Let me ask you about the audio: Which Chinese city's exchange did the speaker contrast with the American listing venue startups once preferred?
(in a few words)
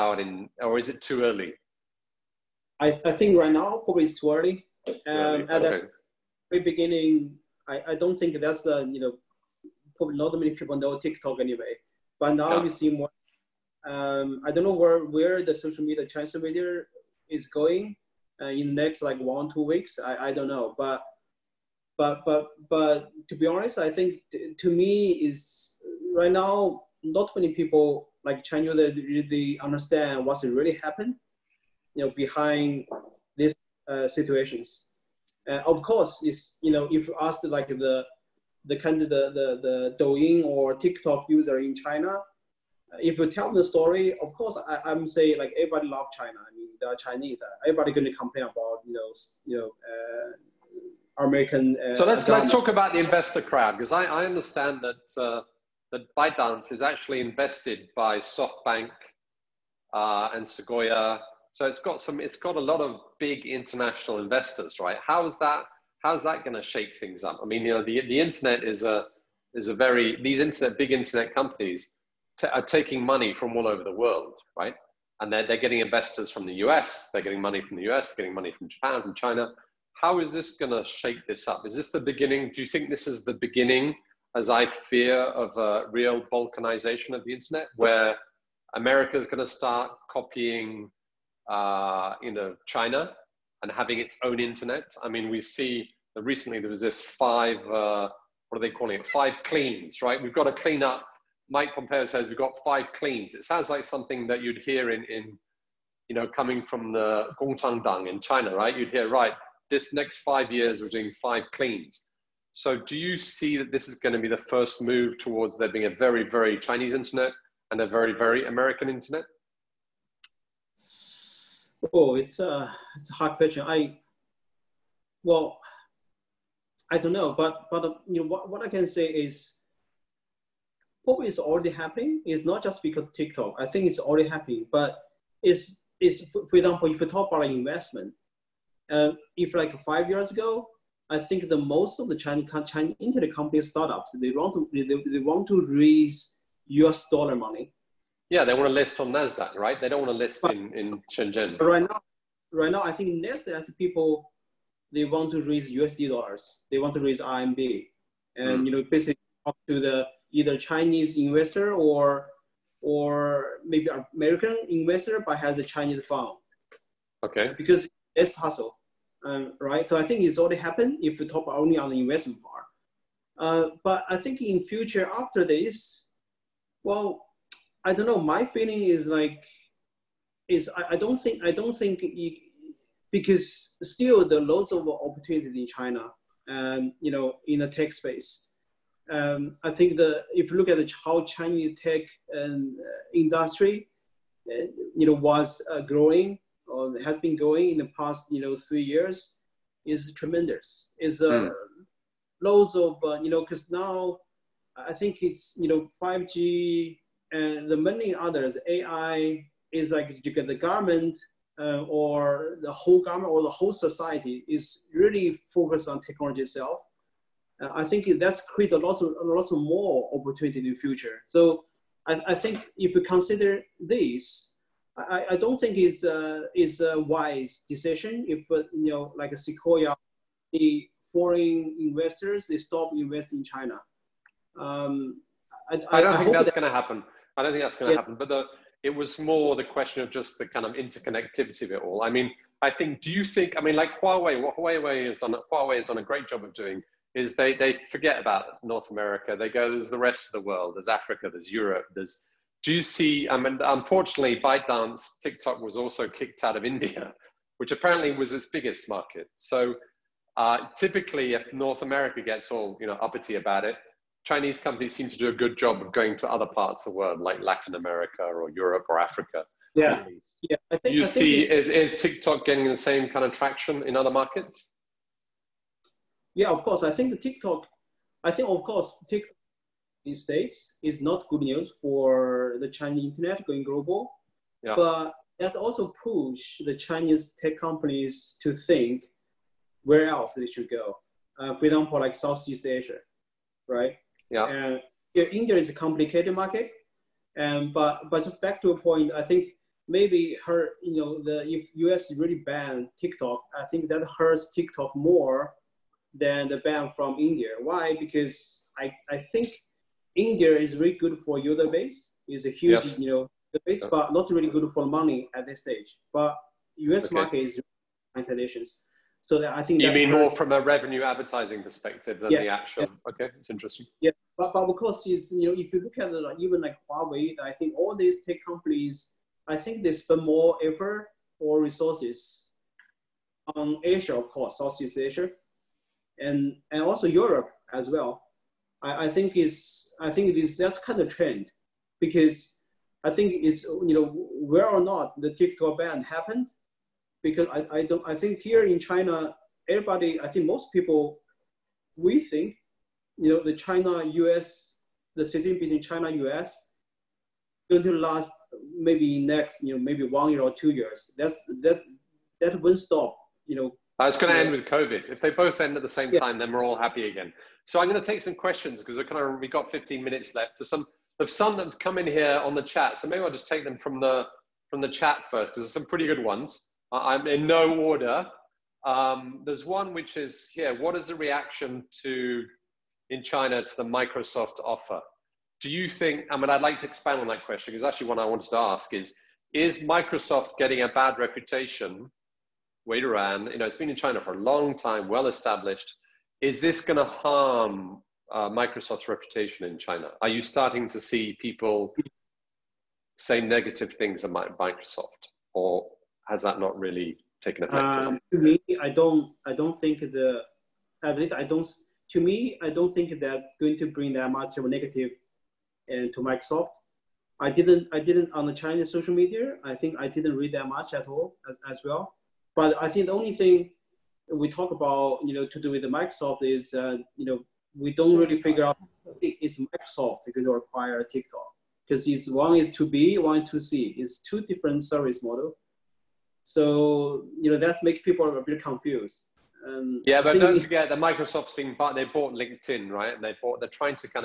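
Shenzhen.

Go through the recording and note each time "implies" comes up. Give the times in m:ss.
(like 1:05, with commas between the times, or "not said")
not said.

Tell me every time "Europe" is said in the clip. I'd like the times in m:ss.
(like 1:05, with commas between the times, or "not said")
4:11, 4:28, 5:37.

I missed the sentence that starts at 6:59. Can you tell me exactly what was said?
I think I didn't read that much at all as, as well.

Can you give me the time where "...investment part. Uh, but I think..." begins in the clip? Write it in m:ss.
2:51.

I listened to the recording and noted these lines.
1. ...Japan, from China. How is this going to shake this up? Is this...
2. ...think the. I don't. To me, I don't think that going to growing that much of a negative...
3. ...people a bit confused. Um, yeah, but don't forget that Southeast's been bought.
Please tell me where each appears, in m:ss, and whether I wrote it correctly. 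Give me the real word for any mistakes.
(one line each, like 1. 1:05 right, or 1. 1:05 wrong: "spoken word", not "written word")
1. 1:18 right
2. 6:49 wrong: "bring", not "growing"
3. 7:18 wrong: "Microsoft", not "Southeast".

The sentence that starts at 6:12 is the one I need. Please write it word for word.
So maybe I'll just take them from the, from the chat first because there's some pretty good ones.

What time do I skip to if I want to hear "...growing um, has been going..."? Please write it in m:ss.
3:15.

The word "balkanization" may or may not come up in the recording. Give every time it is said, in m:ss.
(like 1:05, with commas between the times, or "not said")
1:26.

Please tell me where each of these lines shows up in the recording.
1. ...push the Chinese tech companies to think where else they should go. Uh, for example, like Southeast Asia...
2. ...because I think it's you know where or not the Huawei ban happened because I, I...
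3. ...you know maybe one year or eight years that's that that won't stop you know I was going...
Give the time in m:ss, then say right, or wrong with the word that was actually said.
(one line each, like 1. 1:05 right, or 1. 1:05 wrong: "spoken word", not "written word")
1. 4:46 right
2. 5:41 wrong: "TikTok", not "Huawei"
3. 5:59 wrong: "two", not "eight".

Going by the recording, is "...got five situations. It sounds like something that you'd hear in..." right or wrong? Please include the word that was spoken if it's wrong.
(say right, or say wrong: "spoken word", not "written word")
wrong: "cleans", not "situations".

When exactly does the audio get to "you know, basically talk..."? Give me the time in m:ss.
2:38.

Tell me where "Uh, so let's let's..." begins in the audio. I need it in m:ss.
0:51.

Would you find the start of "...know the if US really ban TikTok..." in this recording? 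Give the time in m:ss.
5:00.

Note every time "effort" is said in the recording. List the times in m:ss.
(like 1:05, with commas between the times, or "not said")
5:30.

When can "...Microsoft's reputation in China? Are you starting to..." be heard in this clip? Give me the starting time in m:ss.
6:38.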